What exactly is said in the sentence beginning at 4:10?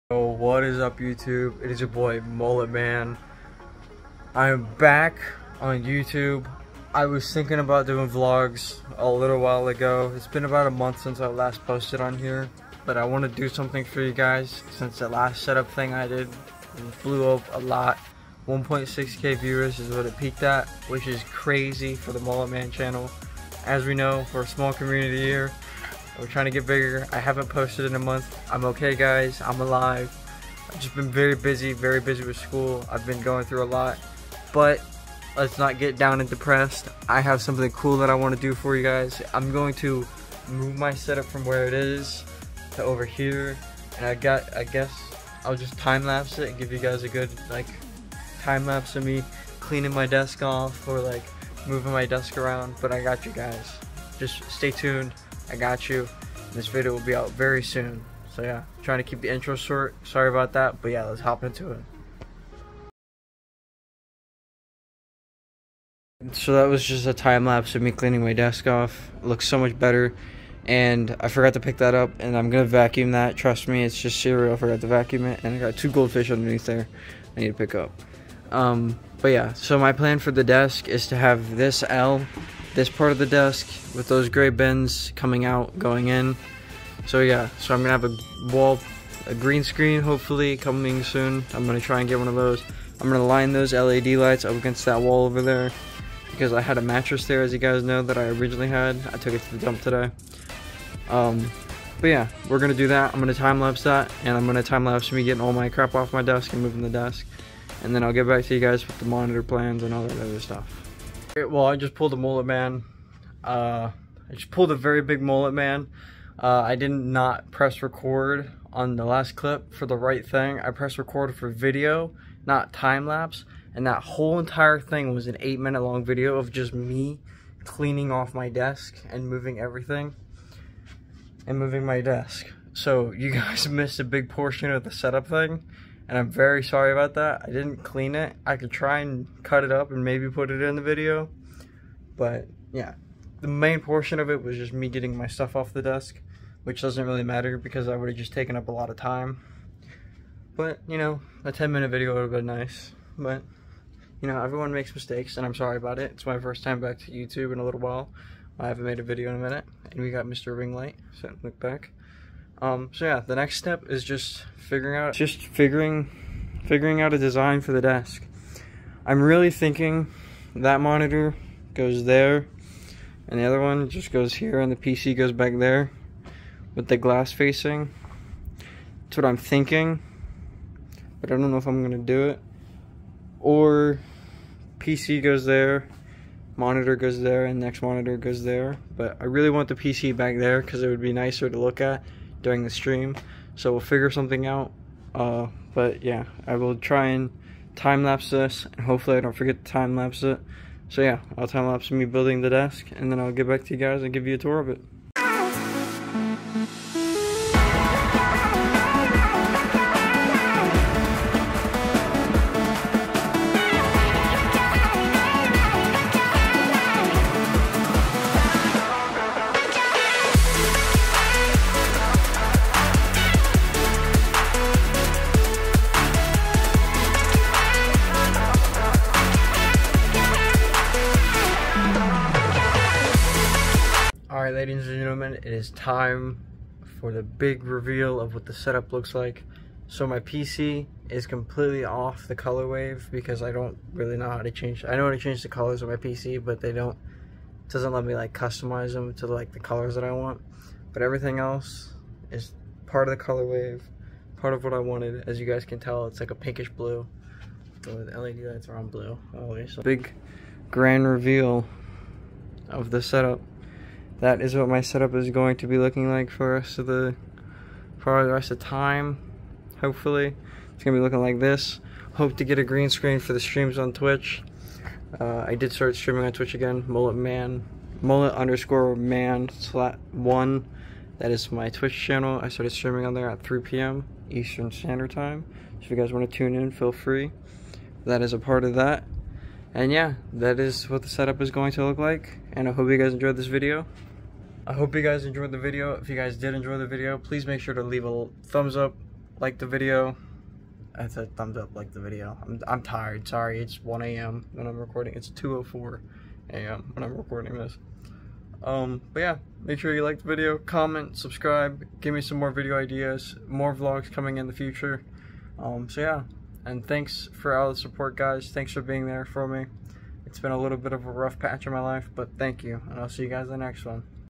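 But everything else is part of the color wave, part of what I wanted.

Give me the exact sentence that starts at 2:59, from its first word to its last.
That's what I'm thinking, but I don't know if I'm gonna do it.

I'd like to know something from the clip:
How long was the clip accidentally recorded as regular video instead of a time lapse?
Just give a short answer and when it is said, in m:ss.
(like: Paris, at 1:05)
8 minutes, at 2:05.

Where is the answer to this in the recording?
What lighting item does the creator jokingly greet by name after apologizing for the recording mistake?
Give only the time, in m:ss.
2:40.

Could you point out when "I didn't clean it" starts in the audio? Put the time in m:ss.
2:17.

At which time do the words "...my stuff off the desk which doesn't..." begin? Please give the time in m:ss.
2:25.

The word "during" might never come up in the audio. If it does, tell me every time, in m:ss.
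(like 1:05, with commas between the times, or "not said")
3:12.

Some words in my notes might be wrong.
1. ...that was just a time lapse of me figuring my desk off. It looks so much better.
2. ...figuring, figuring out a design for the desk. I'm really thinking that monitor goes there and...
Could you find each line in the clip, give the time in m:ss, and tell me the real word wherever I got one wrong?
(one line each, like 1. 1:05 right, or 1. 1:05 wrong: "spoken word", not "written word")
1. 1:06 wrong: "cleaning", not "figuring"
2. 2:45 right.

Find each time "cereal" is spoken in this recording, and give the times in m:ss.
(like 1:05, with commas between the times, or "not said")
1:14.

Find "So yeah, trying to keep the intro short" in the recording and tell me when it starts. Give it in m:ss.
0:58.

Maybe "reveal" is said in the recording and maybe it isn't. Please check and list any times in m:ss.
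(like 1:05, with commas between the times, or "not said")
3:57, 4:21.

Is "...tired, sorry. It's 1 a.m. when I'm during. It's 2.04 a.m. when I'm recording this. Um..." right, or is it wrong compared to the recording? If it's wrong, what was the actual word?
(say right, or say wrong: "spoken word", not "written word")
wrong: "recording", not "during".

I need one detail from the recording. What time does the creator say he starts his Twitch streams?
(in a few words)
3 p.m. Eastern.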